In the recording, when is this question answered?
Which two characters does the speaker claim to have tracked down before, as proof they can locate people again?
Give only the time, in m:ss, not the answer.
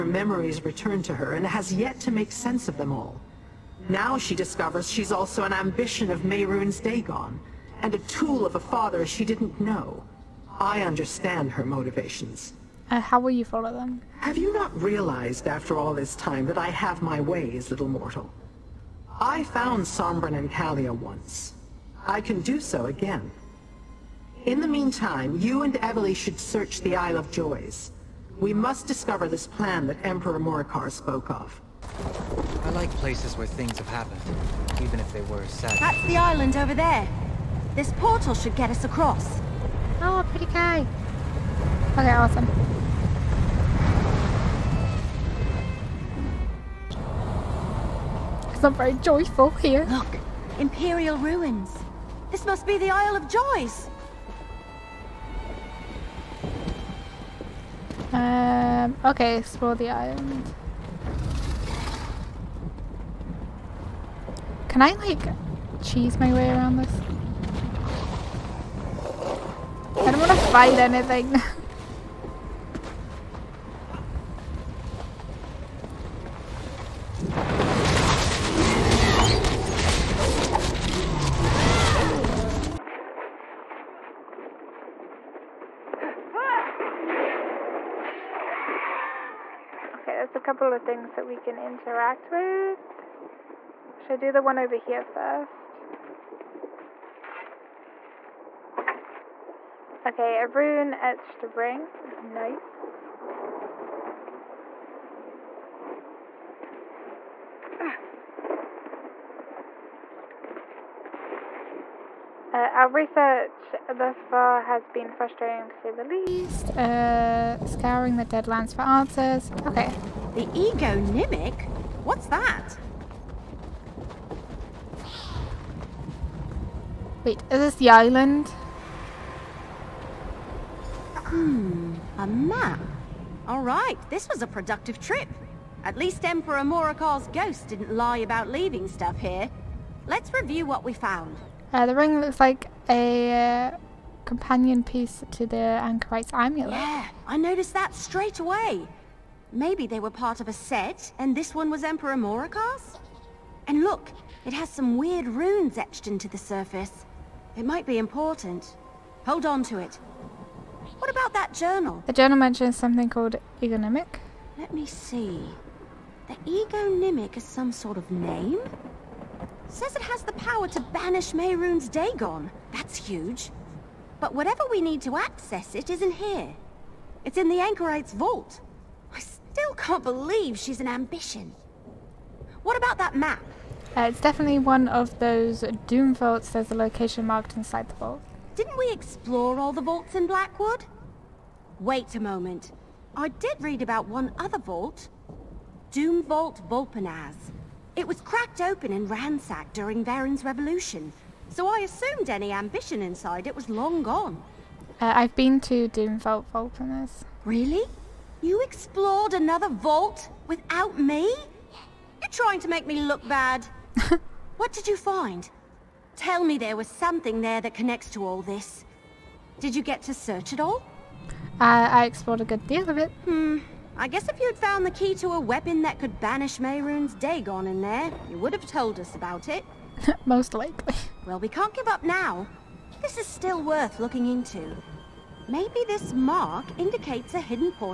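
0:19.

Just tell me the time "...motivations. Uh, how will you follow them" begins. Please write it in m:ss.
0:11.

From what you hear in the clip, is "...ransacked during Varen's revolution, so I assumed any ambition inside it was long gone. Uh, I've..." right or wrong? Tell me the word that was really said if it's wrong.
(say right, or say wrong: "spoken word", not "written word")
right.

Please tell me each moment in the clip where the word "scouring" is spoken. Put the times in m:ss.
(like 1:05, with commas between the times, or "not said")
1:57.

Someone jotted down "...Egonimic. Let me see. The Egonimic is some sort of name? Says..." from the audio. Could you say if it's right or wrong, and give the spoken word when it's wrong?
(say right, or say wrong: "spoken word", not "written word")
right.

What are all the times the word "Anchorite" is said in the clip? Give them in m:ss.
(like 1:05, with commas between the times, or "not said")
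2:25, 2:57.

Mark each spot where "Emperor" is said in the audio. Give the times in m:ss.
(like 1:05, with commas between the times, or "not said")
0:30, 2:16, 2:31.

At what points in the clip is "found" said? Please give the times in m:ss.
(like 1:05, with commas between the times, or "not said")
0:19, 2:20, 3:44.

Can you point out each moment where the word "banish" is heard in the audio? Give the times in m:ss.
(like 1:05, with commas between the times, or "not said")
2:50, 3:46.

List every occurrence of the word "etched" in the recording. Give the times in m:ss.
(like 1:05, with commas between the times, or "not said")
1:40, 2:35.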